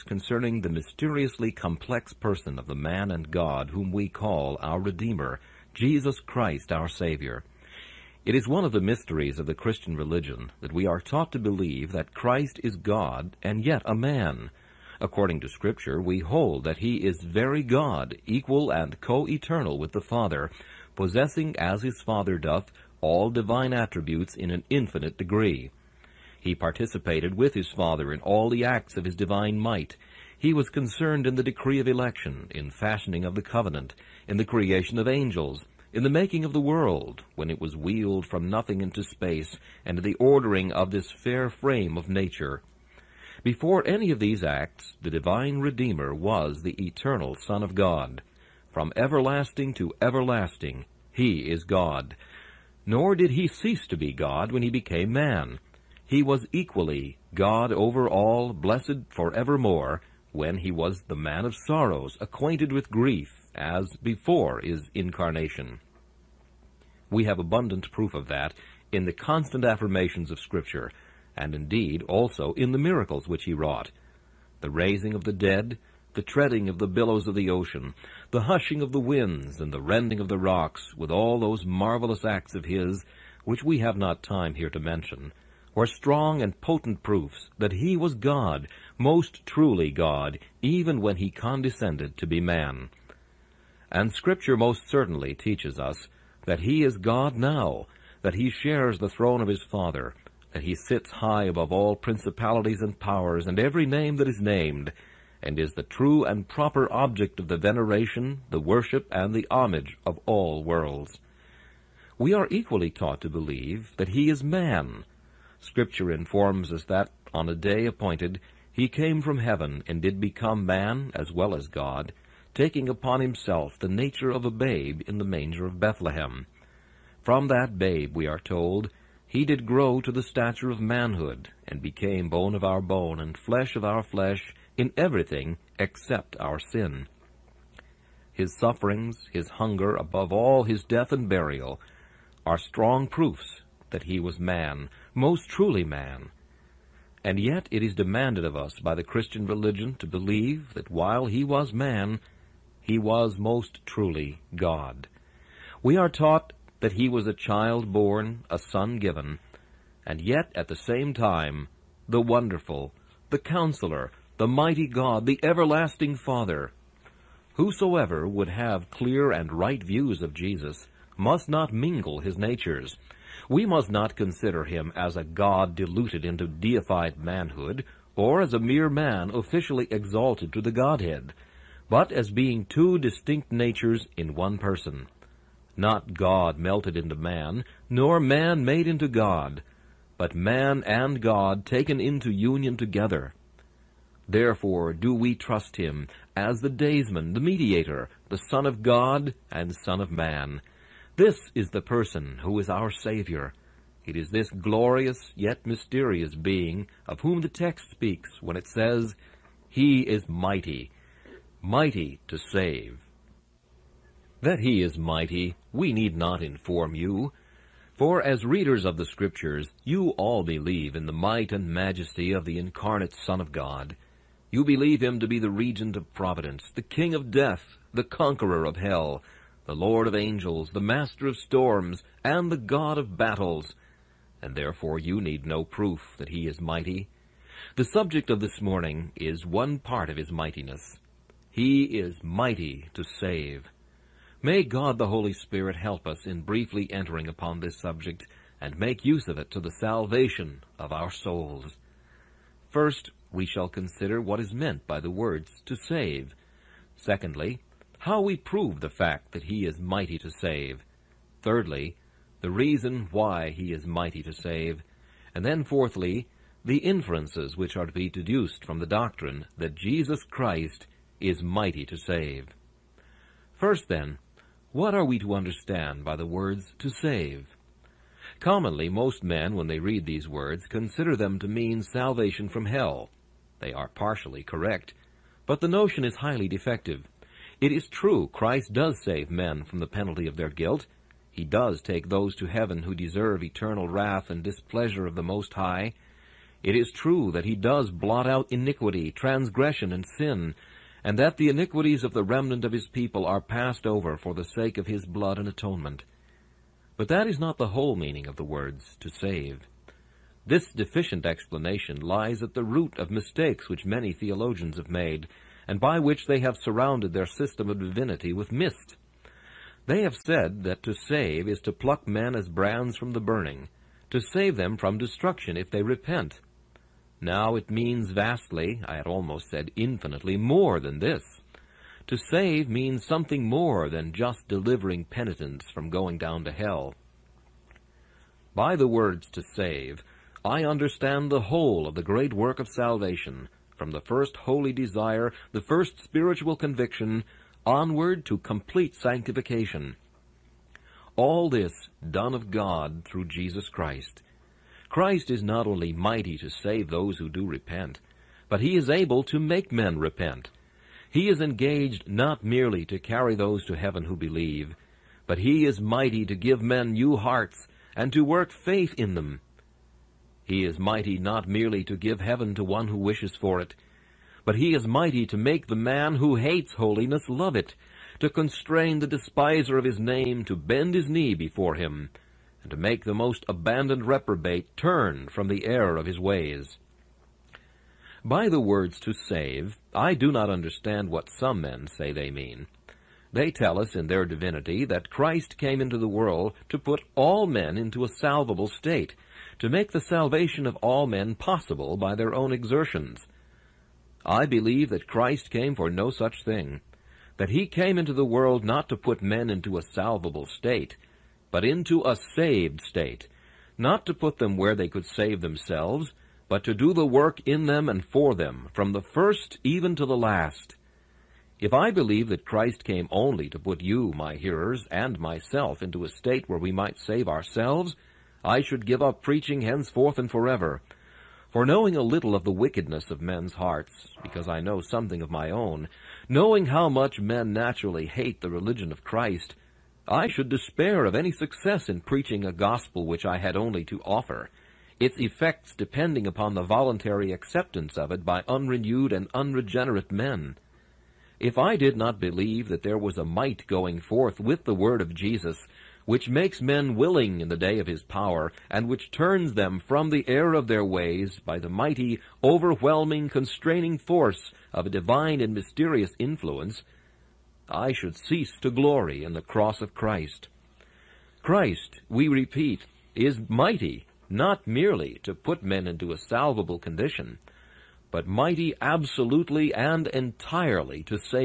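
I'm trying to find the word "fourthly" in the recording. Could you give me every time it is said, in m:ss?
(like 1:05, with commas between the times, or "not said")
4:25.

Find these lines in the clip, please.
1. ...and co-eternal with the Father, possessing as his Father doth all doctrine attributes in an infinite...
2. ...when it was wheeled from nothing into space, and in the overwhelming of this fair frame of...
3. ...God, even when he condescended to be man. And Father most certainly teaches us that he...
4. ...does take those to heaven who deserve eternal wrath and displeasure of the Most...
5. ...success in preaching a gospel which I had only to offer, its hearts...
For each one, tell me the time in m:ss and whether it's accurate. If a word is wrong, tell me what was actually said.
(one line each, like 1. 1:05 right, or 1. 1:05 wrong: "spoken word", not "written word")
1. 0:18 wrong: "divine", not "doctrine"
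2. 0:37 wrong: "ordering", not "overwhelming"
3. 1:29 wrong: "Scripture", not "Father"
4. 4:51 right
5. 7:21 wrong: "effects", not "hearts".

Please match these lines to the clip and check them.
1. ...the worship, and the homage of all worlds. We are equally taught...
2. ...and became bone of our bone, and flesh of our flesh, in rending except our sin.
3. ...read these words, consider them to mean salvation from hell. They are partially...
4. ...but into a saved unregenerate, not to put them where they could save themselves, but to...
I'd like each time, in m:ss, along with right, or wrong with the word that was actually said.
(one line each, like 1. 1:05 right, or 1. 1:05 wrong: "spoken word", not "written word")
1. 1:48 right
2. 2:11 wrong: "everything", not "rending"
3. 4:39 right
4. 6:51 wrong: "state", not "unregenerate".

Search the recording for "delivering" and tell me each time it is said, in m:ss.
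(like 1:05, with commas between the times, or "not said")
5:34.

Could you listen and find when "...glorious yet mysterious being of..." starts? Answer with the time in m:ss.
3:24.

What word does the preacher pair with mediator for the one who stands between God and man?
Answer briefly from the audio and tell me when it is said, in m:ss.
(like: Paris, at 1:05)
daysman, at 3:16.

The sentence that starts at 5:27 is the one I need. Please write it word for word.
Now it means vastly, I had almost said infinitely, more than this.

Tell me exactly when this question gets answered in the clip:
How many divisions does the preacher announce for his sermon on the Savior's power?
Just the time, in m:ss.
4:25.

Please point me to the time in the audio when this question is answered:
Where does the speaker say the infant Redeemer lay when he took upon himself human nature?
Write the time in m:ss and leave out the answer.
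2:05.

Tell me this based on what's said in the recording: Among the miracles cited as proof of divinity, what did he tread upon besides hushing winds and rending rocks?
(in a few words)
the billows of the ocean.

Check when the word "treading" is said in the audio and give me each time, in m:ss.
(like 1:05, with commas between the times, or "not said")
1:16.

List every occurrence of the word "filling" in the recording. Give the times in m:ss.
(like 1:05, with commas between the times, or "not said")
not said.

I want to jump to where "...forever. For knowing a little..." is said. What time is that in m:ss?
7:10.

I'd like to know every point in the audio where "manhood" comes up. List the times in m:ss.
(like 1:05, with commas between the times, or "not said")
2:10, 2:57.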